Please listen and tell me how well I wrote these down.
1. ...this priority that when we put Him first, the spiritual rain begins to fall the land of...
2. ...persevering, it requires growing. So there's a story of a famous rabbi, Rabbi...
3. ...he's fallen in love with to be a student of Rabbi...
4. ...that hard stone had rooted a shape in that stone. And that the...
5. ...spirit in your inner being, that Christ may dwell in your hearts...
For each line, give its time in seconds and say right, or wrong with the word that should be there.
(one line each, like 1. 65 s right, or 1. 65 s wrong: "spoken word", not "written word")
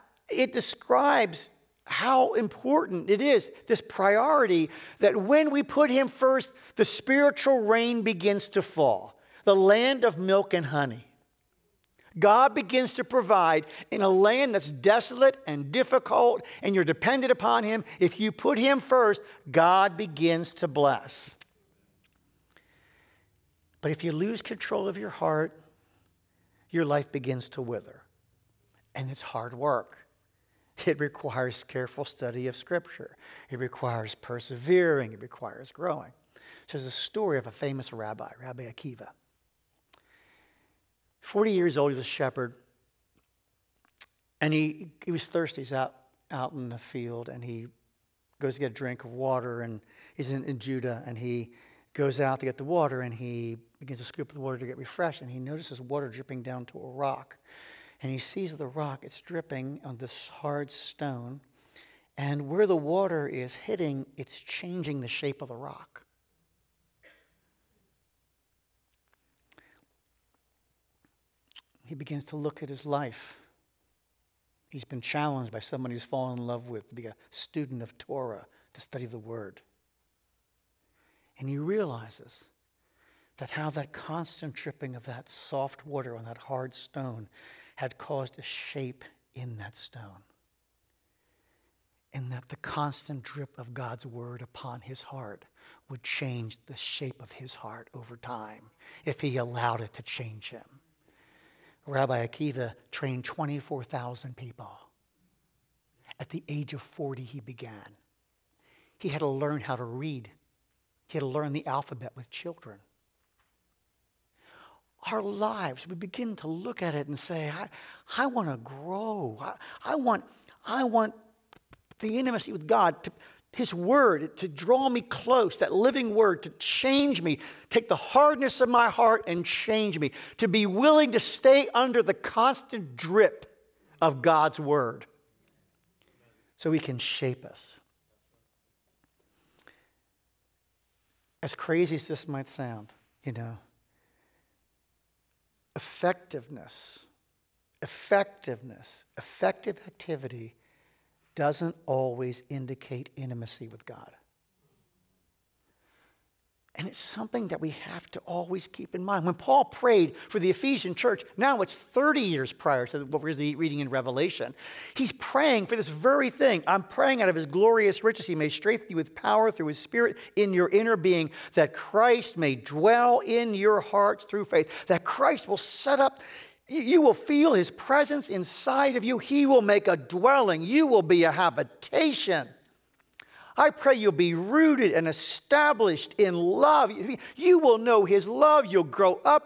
1. 3 s right
2. 34 s right
3. 75 s wrong: "Torah", not "Rabbi"
4. 86 s wrong: "caused", not "rooted"
5. 169 s right.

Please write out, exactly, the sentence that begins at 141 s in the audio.
As crazy as this might sound, you know, effectiveness, effectiveness, effective activity doesn't always indicate intimacy with God.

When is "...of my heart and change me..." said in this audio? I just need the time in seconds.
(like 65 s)
128 s.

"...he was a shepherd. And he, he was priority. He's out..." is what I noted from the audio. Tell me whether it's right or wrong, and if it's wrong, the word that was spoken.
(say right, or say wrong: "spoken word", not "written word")
wrong: "thirsty", not "priority".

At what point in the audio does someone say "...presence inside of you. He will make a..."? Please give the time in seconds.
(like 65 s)
177 s.